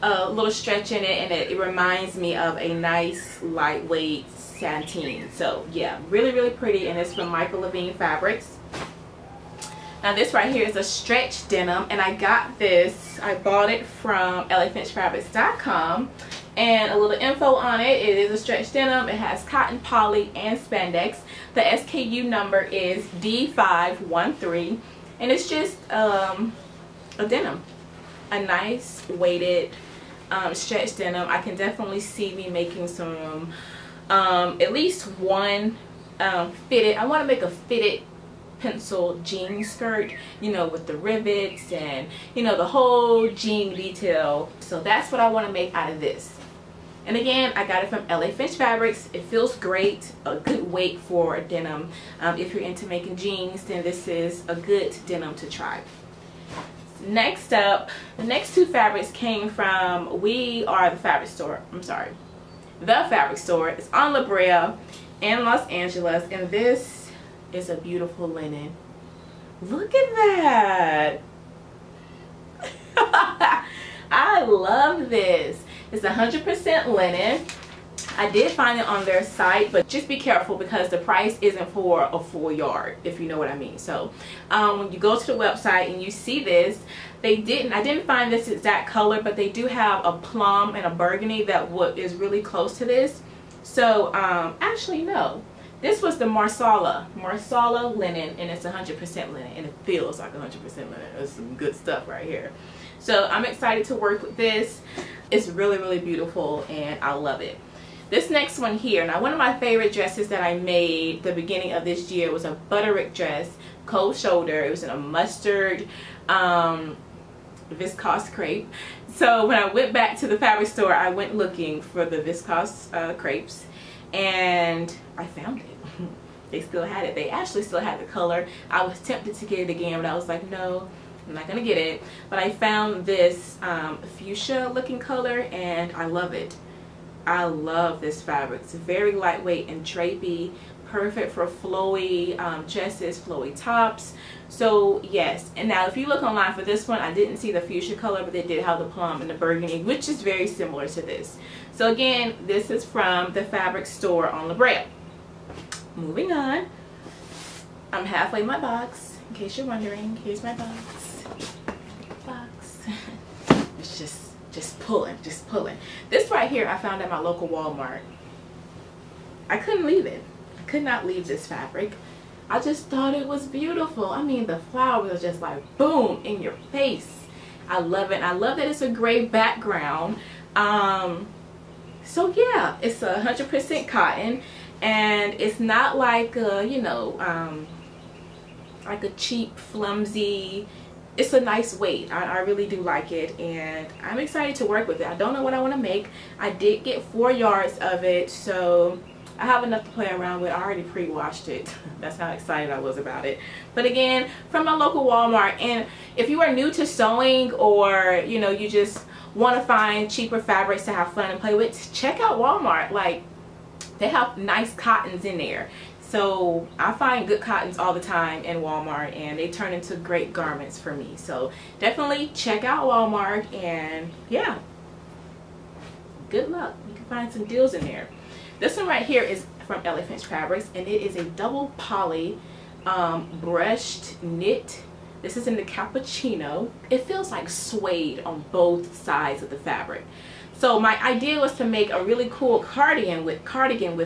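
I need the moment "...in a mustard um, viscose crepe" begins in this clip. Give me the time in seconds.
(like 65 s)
114 s.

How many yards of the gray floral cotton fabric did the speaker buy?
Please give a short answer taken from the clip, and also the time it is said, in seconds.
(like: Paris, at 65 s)
4, at 197 s.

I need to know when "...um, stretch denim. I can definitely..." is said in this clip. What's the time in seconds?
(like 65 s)
30 s.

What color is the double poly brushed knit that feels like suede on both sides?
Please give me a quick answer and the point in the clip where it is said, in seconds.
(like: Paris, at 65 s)
cappuccino, at 235 s.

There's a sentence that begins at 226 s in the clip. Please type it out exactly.
You can find some deals in there.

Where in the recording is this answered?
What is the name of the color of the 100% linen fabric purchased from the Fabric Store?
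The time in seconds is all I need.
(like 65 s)
97 s.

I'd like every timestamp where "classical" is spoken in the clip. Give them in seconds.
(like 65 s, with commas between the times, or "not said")
not said.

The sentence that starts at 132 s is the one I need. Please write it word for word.
But I found this um, fuchsia looking color and I love it.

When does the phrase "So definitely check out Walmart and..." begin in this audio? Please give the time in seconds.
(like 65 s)
221 s.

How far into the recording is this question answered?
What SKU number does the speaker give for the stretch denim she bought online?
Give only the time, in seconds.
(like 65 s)
23 s.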